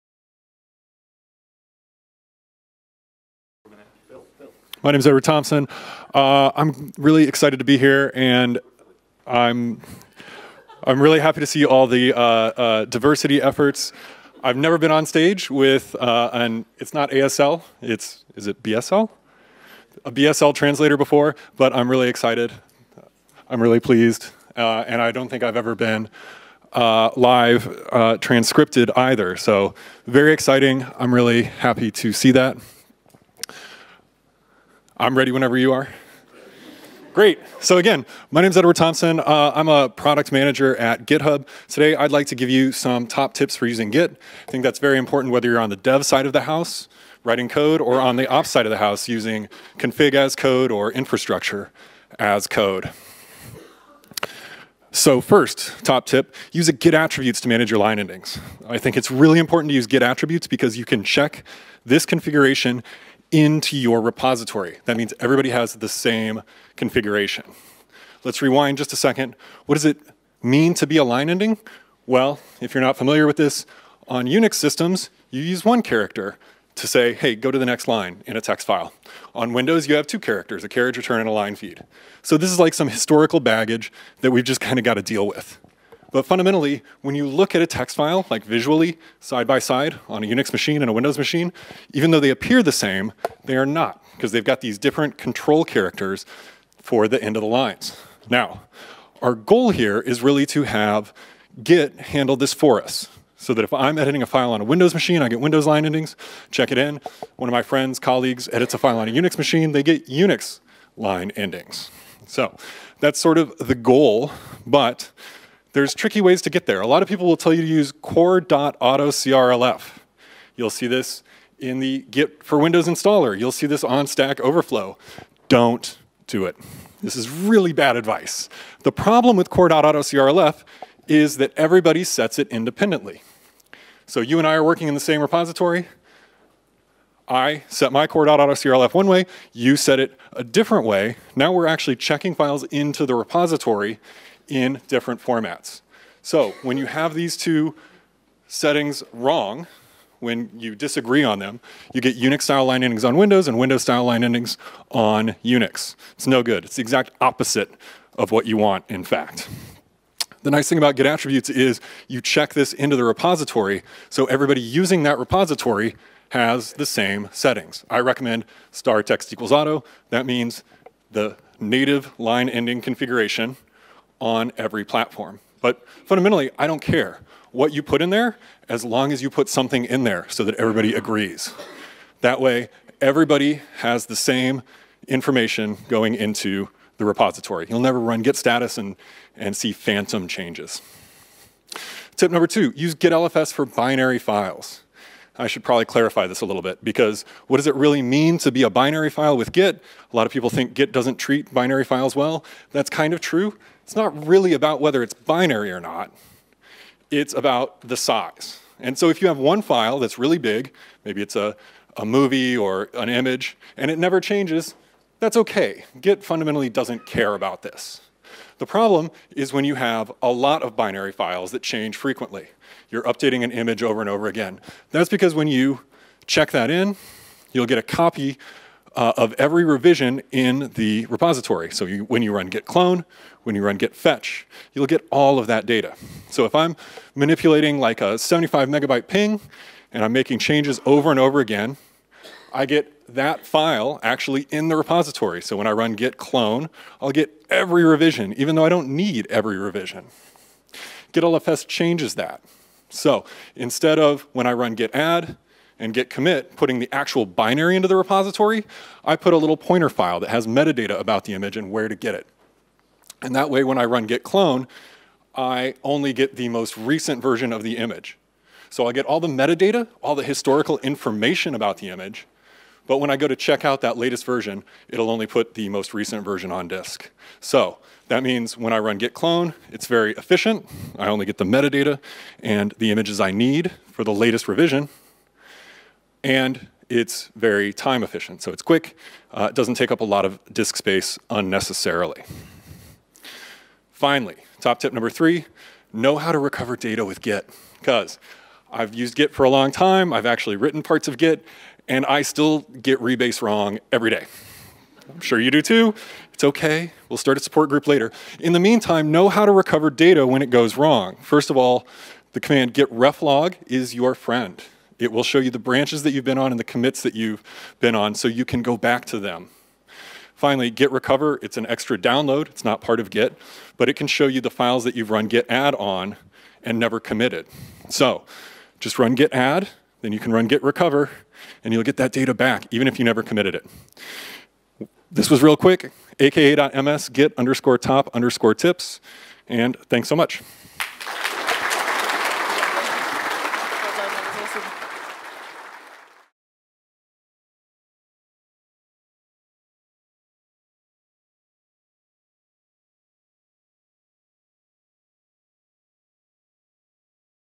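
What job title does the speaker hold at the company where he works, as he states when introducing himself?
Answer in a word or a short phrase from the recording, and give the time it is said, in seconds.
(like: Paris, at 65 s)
product manager, at 39 s.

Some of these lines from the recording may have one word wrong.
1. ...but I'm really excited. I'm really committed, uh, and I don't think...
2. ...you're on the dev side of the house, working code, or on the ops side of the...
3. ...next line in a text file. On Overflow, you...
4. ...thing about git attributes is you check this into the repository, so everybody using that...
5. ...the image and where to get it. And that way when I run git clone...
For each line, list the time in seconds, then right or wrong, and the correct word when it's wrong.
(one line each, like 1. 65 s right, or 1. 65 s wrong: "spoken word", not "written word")
1. 21 s wrong: "pleased", not "committed"
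2. 45 s wrong: "writing", not "working"
3. 77 s wrong: "Windows", not "Overflow"
4. 160 s right
5. 261 s right.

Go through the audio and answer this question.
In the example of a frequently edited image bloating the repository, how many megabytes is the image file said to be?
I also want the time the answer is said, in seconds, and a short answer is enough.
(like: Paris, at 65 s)
75, at 238 s.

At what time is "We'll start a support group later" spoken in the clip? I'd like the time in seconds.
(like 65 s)
307 s.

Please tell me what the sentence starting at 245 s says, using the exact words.
So when I run git clone, I'll get every revision, even though I don't need every revision.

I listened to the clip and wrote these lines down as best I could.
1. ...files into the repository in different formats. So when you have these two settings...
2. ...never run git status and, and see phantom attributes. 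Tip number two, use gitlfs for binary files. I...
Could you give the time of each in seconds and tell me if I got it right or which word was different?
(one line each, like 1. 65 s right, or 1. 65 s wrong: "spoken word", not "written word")
1. 142 s right
2. 187 s wrong: "changes", not "attributes".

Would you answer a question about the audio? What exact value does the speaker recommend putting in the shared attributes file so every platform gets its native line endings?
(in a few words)
star text equals auto.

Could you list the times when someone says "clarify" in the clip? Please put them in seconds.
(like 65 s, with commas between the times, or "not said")
195 s.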